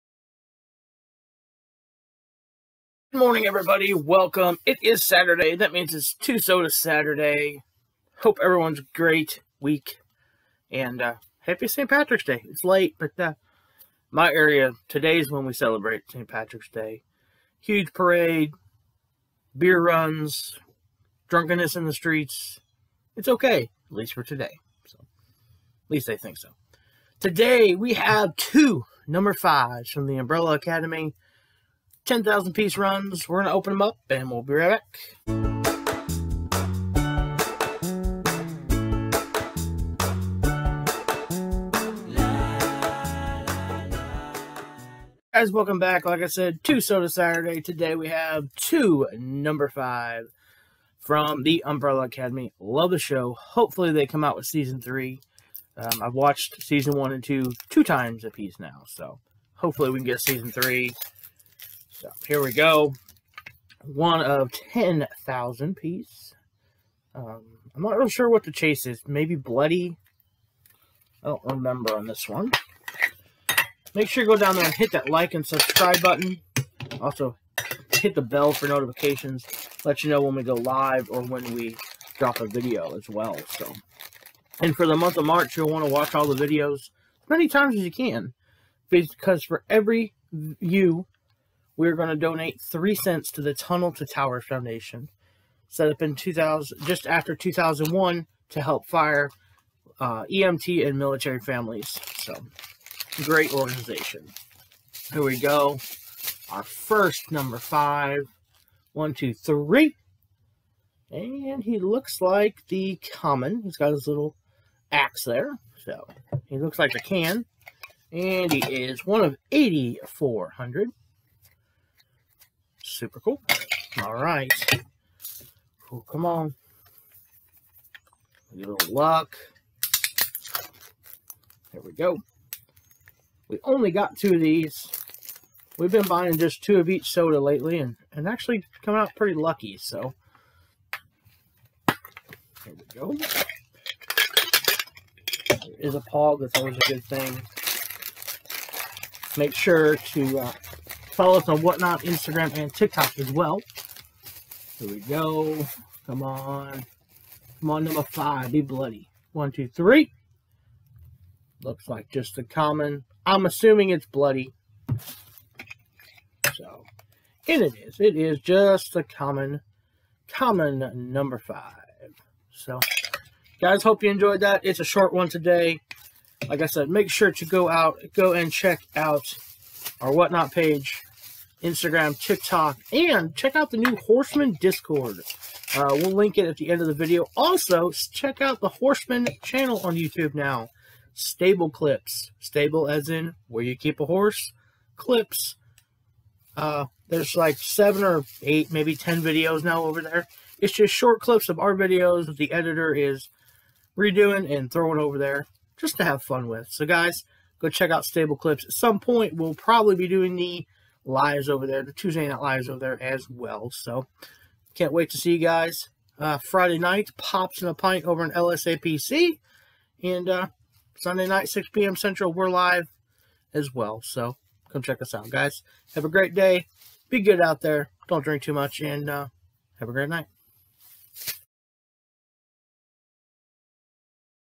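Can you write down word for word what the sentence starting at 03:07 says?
Also, check out the Horseman channel on YouTube now.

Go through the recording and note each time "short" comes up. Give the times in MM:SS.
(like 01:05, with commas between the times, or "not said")
02:54, 03:20.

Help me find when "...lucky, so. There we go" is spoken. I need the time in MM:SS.
02:19.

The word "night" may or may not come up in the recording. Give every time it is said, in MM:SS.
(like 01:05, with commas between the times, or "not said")
03:32, 03:36, 03:41, 03:50.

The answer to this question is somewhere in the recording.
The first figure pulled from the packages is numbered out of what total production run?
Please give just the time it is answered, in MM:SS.
01:59.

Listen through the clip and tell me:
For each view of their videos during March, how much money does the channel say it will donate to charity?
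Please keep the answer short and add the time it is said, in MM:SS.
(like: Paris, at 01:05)
3 cents, at 01:32.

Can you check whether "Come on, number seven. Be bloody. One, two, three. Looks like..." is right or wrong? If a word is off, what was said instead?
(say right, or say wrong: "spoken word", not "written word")
wrong: "five", not "seven".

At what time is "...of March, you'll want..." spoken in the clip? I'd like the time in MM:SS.
01:25.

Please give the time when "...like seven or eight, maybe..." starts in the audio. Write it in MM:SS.
03:17.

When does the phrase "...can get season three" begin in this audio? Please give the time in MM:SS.
00:59.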